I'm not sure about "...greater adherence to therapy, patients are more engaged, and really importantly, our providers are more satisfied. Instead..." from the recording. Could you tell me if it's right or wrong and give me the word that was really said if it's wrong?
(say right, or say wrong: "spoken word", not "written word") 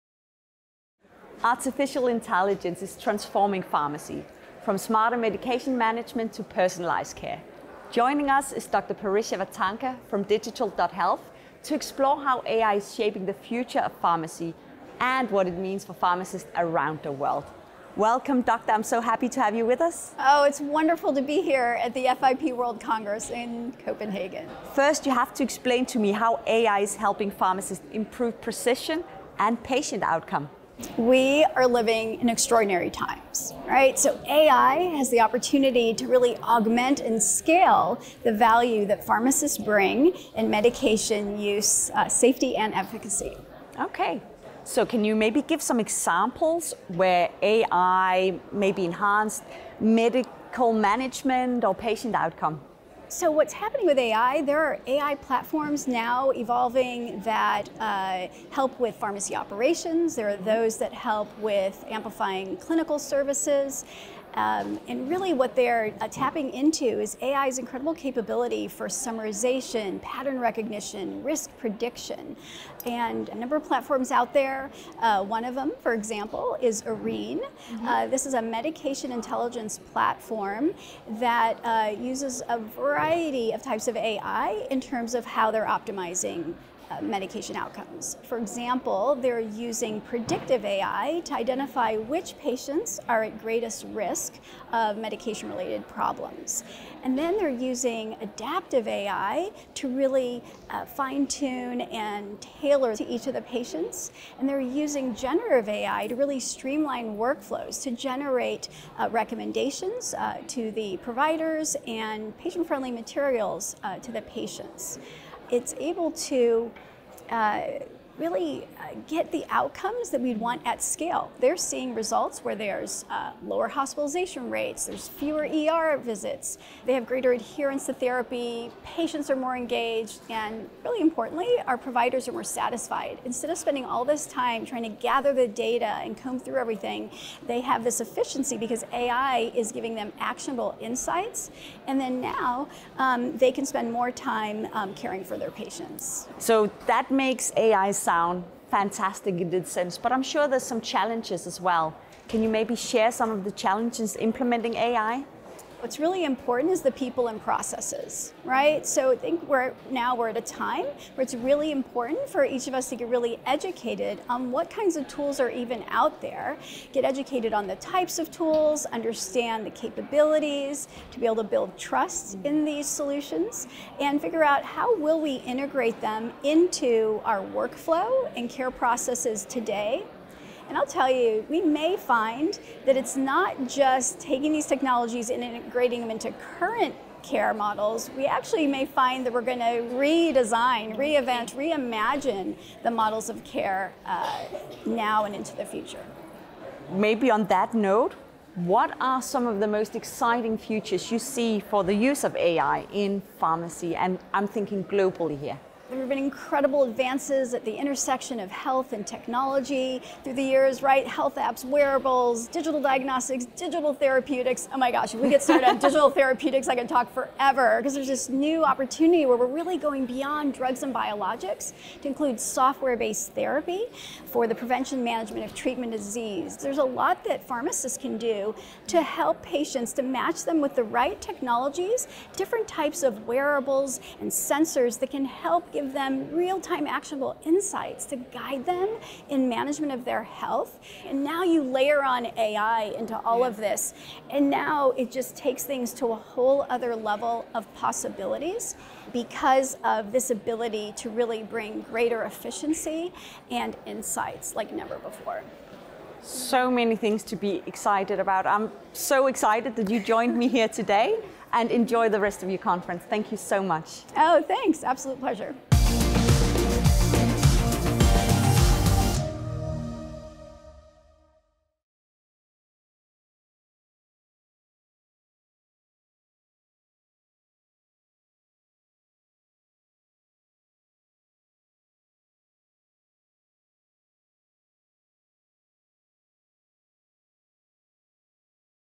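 right.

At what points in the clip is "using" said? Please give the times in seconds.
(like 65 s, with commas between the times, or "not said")
89 s, 97 s, 104 s.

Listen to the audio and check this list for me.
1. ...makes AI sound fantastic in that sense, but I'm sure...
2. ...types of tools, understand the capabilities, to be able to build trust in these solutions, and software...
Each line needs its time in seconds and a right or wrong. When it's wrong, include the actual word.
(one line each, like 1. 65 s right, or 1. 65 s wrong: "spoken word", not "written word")
1. 147 s right
2. 167 s wrong: "figure", not "software".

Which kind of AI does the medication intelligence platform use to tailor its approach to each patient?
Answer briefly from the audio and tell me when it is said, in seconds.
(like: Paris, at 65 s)
adaptive AI, at 98 s.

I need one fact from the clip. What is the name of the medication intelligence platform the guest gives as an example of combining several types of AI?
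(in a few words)
Arine.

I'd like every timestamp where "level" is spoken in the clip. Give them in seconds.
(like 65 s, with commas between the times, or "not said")
246 s.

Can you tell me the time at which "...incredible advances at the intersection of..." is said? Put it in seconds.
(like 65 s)
206 s.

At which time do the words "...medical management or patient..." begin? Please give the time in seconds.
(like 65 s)
49 s.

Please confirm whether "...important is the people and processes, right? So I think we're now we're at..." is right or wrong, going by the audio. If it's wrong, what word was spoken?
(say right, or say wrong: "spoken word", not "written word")
right.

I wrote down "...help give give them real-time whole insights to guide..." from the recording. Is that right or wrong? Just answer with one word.
wrong.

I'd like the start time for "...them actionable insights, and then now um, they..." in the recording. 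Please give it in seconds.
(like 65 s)
139 s.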